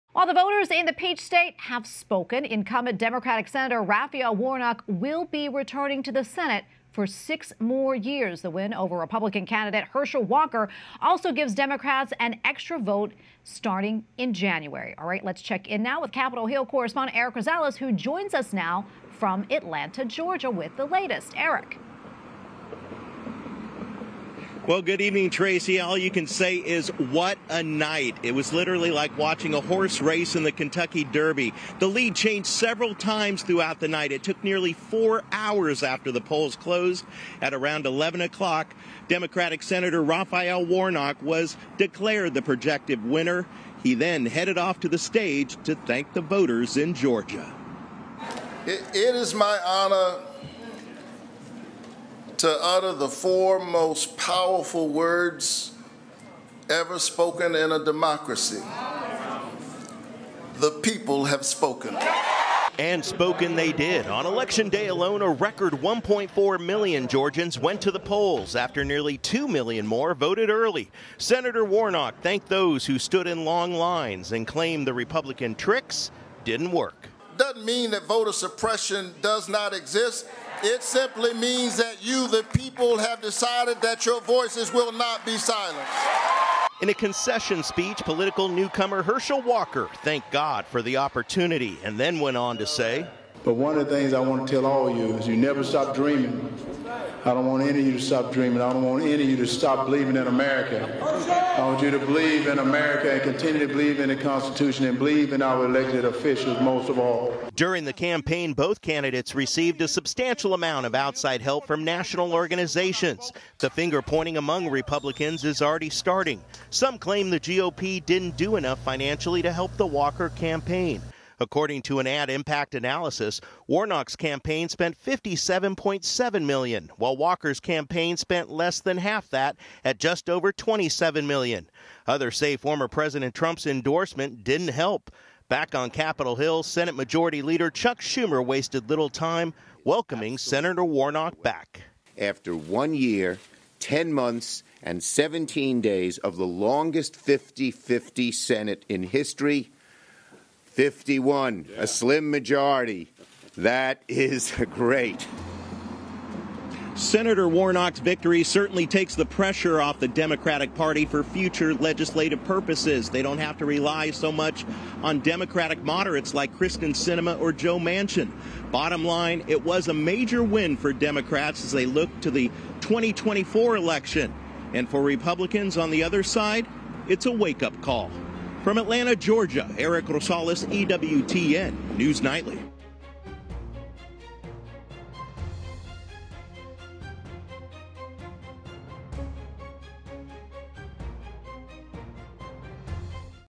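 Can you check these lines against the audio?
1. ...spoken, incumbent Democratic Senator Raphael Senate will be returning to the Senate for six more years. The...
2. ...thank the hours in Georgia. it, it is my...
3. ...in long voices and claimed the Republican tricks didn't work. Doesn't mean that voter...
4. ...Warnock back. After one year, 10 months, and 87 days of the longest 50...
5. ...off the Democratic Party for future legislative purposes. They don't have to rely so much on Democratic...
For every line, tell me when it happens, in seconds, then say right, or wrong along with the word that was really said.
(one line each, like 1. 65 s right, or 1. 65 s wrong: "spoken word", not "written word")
1. 1 s wrong: "Warnock", not "Senate"
2. 45 s wrong: "voters", not "hours"
3. 73 s wrong: "lines", not "voices"
4. 140 s wrong: "17", not "87"
5. 159 s right.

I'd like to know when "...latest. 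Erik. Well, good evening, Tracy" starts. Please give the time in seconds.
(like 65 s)
20 s.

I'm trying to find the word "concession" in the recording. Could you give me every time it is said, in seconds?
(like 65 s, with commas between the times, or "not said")
86 s.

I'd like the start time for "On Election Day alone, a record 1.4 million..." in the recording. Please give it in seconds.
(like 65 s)
64 s.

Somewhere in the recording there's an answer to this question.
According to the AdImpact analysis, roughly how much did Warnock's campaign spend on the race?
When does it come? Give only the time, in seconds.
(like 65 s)
125 s.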